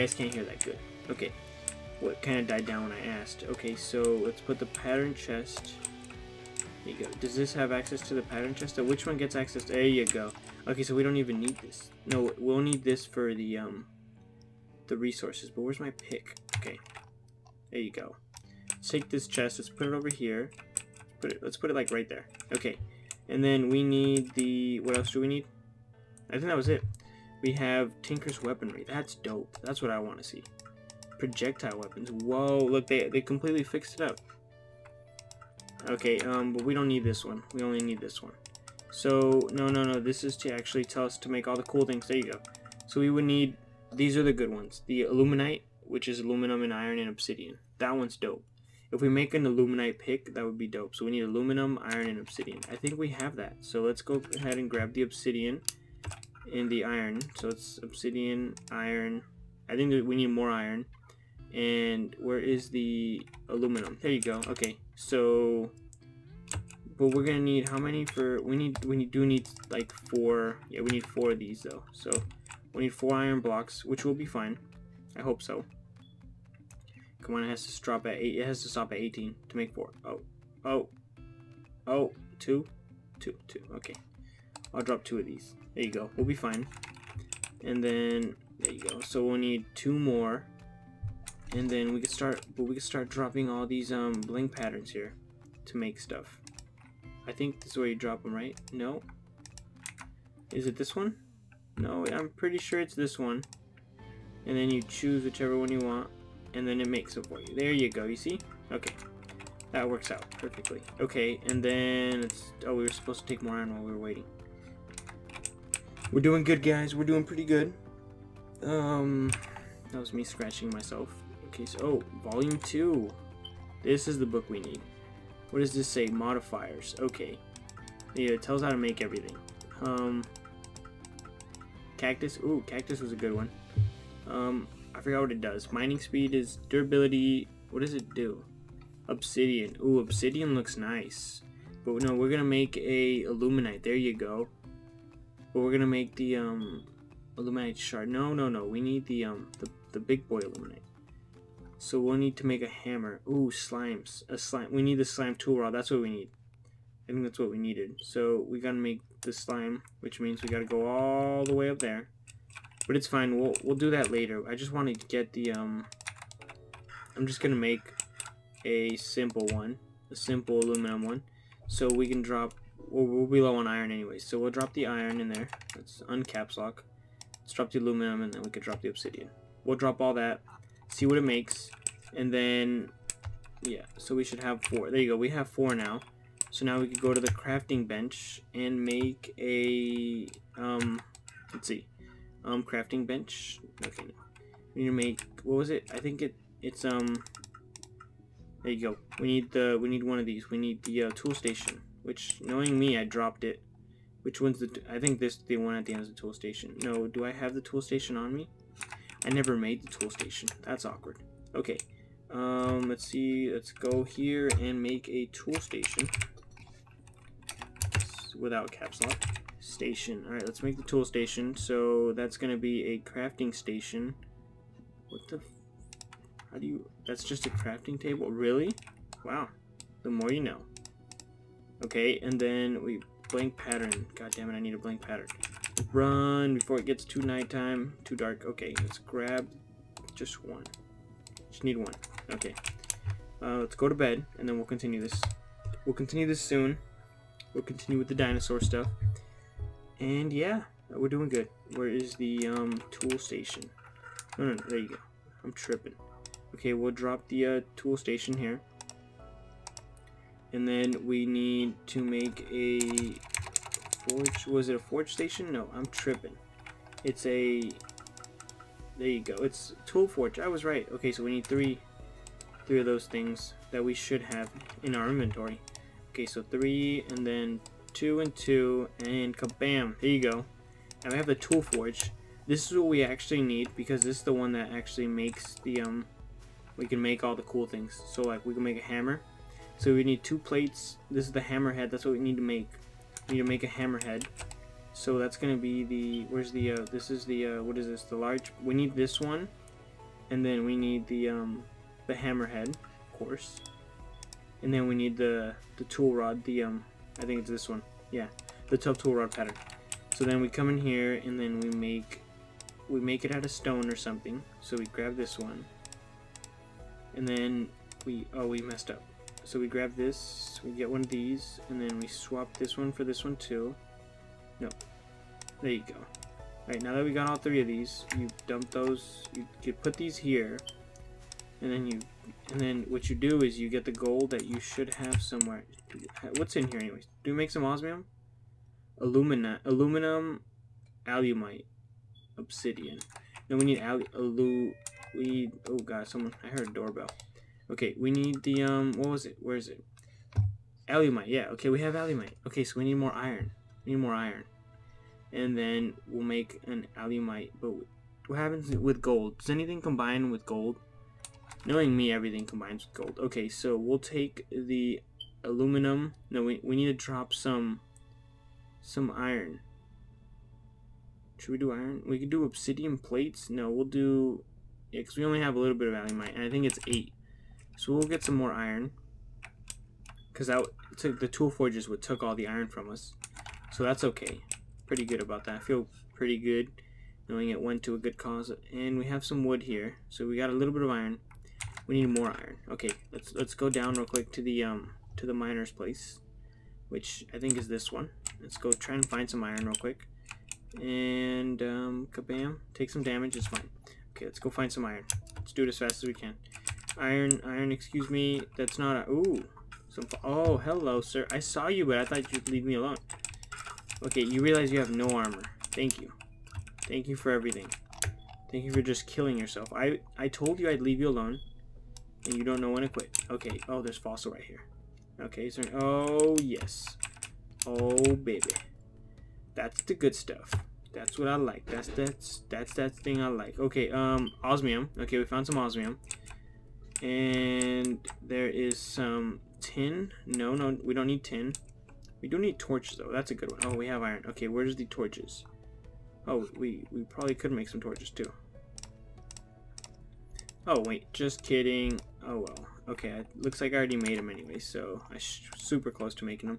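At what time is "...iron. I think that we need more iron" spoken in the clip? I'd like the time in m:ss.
0:58.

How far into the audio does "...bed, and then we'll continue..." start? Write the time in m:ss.
4:03.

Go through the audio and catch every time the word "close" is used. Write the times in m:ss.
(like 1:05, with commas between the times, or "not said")
7:35.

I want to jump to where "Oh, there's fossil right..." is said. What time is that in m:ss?
7:03.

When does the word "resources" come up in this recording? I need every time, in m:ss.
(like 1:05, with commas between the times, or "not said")
0:14.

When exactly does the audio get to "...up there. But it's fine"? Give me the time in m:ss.
2:41.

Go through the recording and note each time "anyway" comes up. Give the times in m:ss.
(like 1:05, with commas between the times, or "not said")
2:53, 5:36, 7:34.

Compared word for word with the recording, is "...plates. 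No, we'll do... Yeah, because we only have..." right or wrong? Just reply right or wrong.
right.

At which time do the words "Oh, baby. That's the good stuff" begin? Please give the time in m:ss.
7:07.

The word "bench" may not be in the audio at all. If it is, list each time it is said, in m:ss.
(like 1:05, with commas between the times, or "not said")
3:07, 3:13.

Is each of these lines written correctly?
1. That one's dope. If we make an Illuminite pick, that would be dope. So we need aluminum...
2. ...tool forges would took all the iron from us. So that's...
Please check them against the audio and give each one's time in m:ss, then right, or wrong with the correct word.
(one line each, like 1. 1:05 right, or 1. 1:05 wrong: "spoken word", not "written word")
1. 0:47 right
2. 6:21 right.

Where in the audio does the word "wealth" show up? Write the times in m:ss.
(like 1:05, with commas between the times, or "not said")
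not said.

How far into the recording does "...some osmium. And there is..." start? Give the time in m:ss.
7:15.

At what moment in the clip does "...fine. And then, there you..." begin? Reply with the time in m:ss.
1:26.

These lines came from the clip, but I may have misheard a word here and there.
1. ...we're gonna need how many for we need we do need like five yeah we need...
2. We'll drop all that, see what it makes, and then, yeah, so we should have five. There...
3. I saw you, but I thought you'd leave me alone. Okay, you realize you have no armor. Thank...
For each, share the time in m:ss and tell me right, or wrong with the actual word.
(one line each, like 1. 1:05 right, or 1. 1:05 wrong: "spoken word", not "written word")
1. 1:07 wrong: "four", not "five"
2. 2:59 wrong: "four", not "five"
3. 6:51 right.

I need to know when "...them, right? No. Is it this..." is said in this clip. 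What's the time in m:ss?
1:38.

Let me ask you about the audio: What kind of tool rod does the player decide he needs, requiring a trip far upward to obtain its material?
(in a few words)
slime tool rod.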